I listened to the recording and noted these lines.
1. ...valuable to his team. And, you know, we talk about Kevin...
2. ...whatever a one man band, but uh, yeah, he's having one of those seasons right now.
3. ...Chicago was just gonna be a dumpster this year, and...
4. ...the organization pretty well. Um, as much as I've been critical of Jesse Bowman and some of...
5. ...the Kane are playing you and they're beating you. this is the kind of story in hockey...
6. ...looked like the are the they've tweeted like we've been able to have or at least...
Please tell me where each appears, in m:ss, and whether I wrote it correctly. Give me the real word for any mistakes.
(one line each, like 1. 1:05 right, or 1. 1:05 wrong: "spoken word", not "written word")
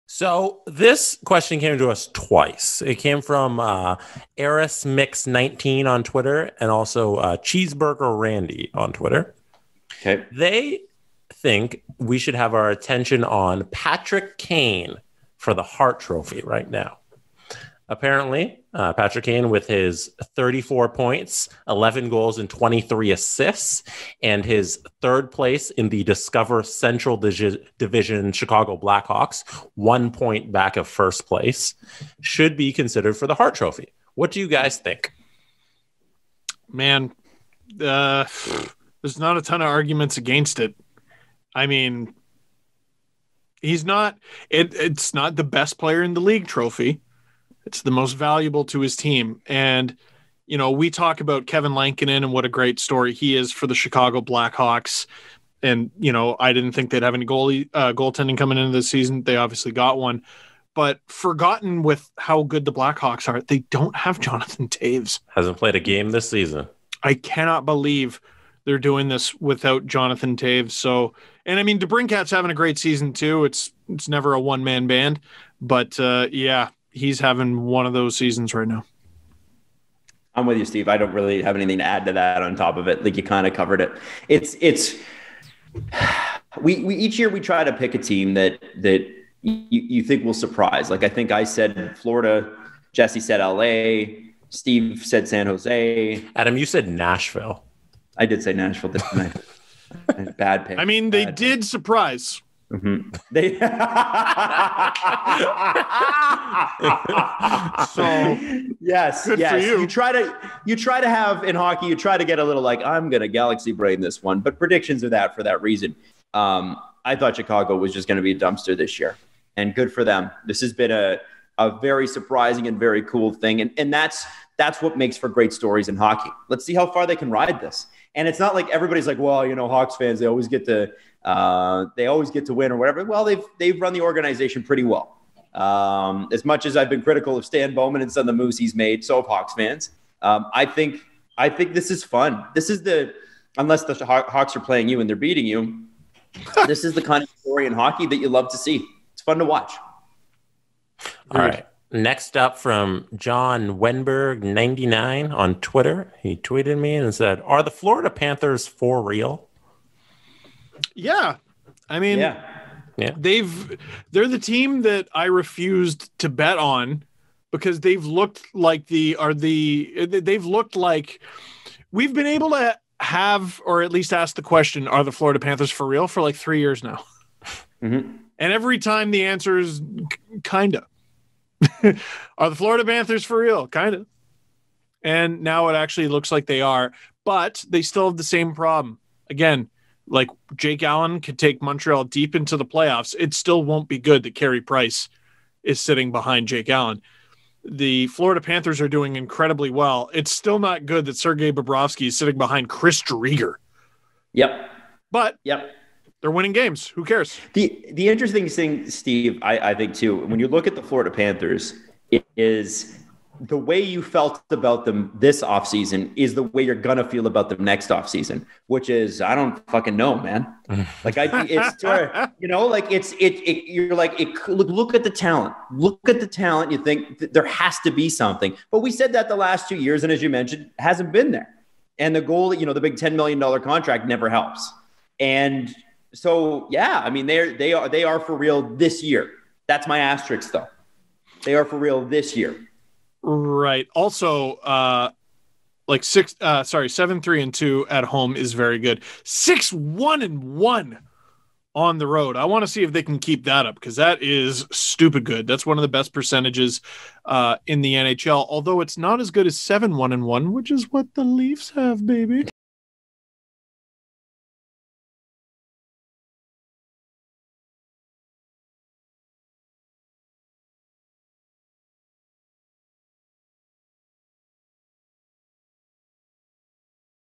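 1. 0:48 right
2. 1:14 wrong: "never", not "whatever"
3. 1:57 right
4. 2:13 wrong: "Stan", not "Jesse"
5. 2:23 wrong: "Hawks", not "Kane"
6. 2:48 wrong: "looked", not "tweeted".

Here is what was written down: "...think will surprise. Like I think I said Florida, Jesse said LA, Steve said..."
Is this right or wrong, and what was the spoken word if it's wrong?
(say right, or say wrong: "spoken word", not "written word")
right.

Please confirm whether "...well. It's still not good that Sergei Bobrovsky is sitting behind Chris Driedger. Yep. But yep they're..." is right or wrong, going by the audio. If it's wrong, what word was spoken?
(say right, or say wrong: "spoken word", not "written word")
right.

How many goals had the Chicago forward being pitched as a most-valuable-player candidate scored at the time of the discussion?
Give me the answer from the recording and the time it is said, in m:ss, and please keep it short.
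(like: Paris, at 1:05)
11, at 0:21.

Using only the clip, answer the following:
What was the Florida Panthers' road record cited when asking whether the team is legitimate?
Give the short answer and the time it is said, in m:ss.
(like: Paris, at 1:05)
6-1-1, at 4:09.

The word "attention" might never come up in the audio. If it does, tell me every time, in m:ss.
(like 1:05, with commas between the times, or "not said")
0:12.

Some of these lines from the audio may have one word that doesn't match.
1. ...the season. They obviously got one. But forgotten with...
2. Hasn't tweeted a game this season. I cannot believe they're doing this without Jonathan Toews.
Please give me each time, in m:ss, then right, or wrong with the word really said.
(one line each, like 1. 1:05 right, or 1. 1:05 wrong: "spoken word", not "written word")
1. 0:58 right
2. 1:05 wrong: "played", not "tweeted".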